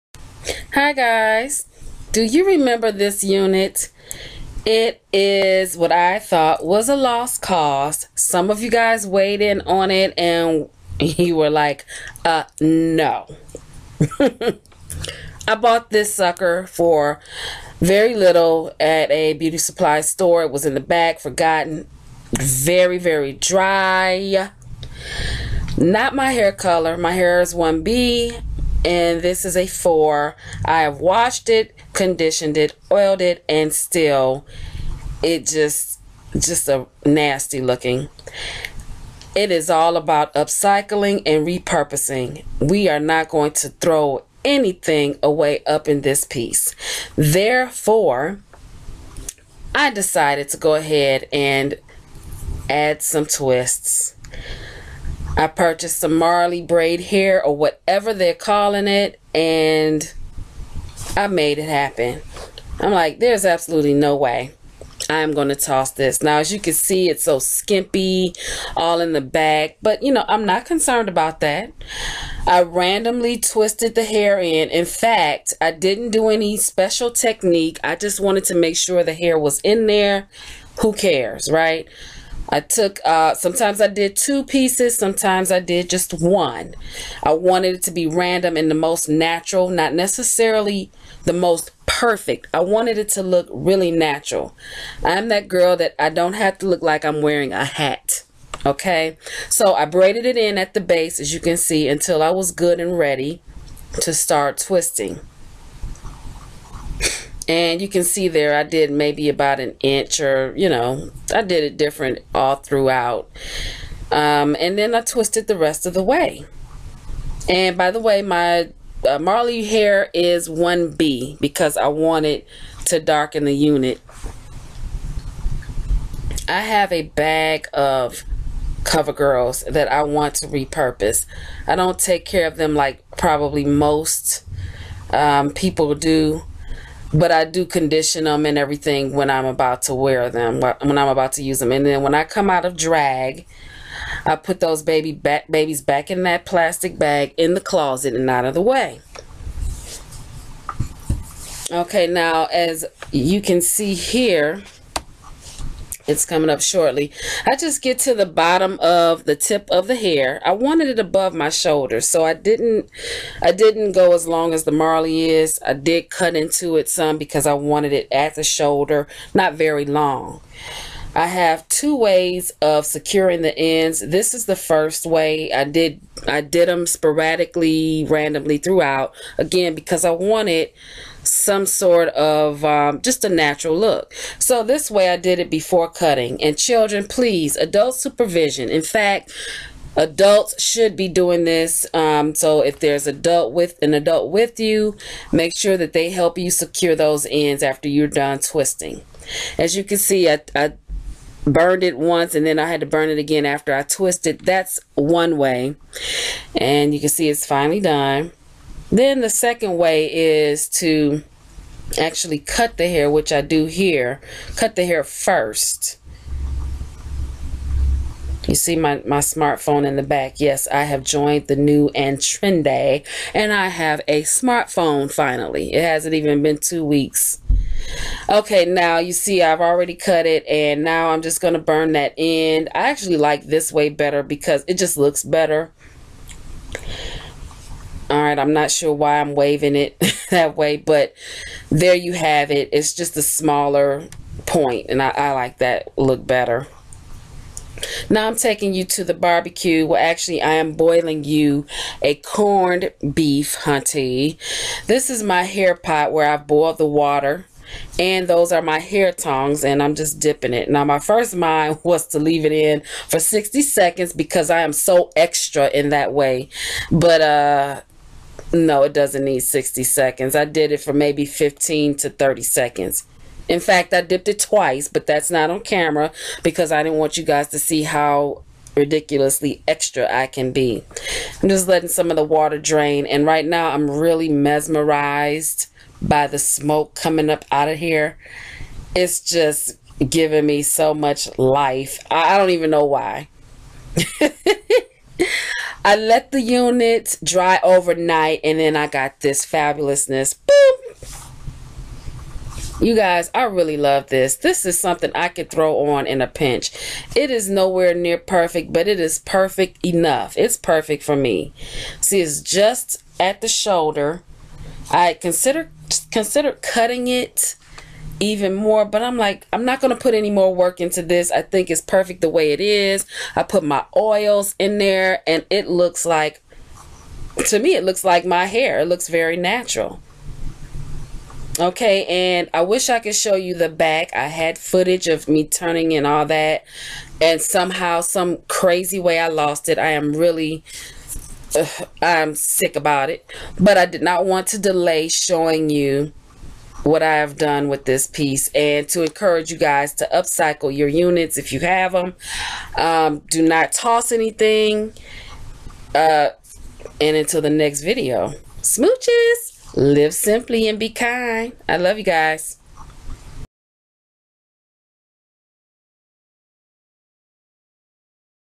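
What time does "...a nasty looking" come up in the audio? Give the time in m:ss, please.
0:36.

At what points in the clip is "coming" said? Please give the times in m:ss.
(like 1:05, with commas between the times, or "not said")
2:36, 4:46.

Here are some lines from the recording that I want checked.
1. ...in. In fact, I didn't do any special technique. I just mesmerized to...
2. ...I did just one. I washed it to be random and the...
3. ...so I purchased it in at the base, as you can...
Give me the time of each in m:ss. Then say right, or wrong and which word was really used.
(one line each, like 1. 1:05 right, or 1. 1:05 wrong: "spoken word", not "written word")
1. 1:14 wrong: "wanted", not "mesmerized"
2. 1:25 wrong: "wanted", not "washed"
3. 1:39 wrong: "braided", not "purchased".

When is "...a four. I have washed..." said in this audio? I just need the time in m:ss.
0:29.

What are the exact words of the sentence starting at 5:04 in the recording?
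This is something I could throw on in a pinch.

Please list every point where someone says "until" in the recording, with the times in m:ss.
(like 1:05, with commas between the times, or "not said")
1:41, 5:57.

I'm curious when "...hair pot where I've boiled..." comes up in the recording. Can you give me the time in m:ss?
4:15.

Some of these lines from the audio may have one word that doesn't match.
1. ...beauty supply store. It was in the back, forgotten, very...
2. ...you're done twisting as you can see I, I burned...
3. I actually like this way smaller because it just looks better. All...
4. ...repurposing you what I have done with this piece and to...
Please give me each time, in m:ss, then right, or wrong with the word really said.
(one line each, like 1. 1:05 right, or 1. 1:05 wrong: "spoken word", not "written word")
1. 0:19 right
2. 3:17 right
3. 3:52 wrong: "better", not "smaller"
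4. 5:45 wrong: "showing", not "repurposing".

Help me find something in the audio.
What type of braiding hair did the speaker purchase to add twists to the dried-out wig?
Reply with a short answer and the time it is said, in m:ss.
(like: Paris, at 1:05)
Marley braid hair, at 0:56.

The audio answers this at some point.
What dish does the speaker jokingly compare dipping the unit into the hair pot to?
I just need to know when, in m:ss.
4:12.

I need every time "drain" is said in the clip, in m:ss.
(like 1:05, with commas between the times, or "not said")
4:42.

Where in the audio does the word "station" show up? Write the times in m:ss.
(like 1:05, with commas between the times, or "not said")
not said.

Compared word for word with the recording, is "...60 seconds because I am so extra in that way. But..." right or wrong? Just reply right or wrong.
right.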